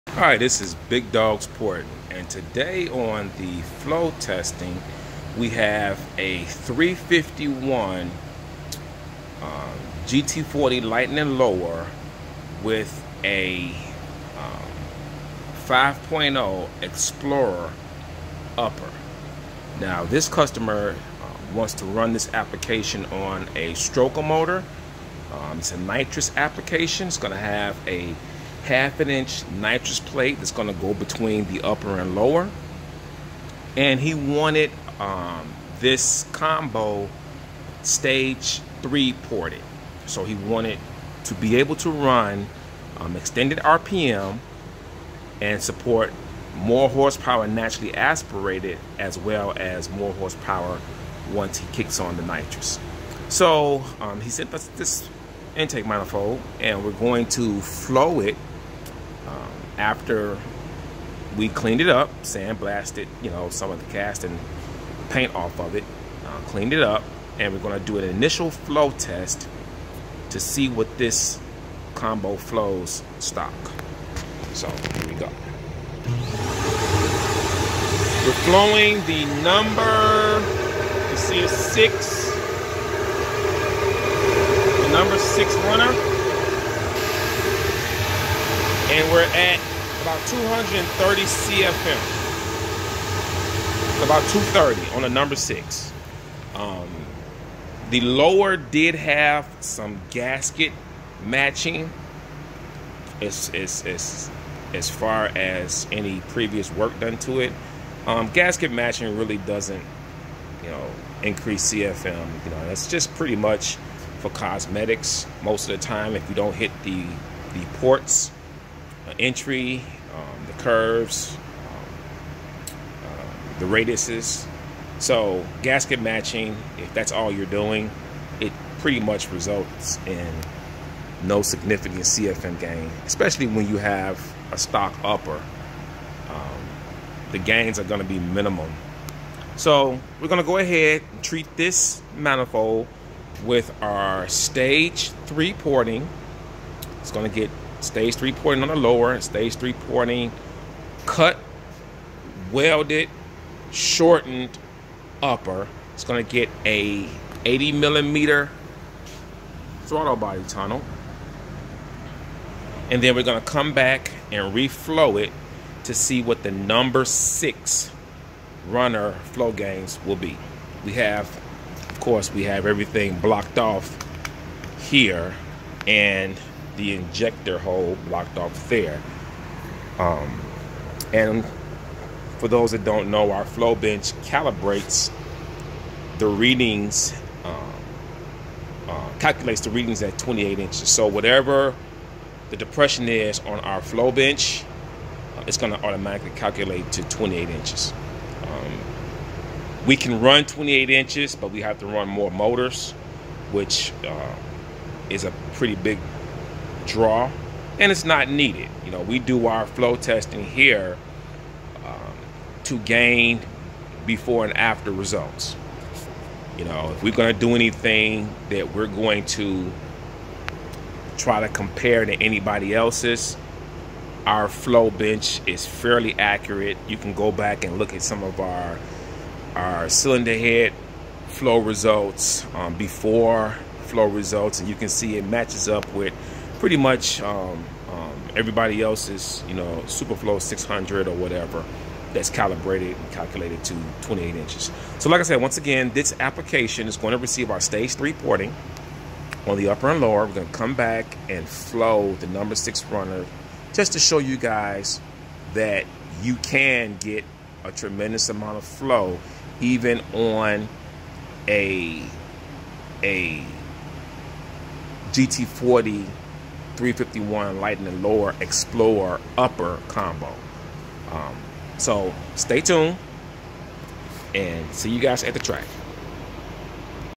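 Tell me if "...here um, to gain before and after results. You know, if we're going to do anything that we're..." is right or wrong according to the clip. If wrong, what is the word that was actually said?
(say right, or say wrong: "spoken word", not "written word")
right.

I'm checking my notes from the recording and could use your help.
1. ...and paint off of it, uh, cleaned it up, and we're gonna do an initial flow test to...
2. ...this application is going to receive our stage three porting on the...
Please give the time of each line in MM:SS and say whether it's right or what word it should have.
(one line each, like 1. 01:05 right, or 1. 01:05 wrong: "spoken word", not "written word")
1. 01:04 right
2. 04:05 right.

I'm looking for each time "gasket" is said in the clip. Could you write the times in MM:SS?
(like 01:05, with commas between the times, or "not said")
01:40, 01:48, 02:05.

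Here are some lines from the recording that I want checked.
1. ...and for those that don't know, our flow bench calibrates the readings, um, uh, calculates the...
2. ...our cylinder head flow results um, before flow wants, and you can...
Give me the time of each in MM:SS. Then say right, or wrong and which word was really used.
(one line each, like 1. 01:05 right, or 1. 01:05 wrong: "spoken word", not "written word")
1. 03:01 right
2. 03:49 wrong: "results", not "wants".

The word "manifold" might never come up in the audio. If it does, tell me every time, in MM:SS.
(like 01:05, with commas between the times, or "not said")
00:55, 02:22.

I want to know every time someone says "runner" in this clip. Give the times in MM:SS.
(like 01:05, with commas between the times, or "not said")
01:25, 02:48, 04:12.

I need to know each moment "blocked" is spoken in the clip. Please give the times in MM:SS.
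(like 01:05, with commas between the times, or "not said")
02:53, 02:58.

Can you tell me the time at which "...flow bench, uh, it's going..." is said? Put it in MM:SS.
03:13.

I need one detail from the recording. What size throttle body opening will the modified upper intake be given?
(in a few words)
80 millimeter.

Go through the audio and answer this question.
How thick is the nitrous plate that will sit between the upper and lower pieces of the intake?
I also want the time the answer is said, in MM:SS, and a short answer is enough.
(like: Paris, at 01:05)
half an inch, at 00:28.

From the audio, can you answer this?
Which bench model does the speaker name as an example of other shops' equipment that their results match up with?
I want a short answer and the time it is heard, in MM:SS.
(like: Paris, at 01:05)
Superflow 600, at 03:59.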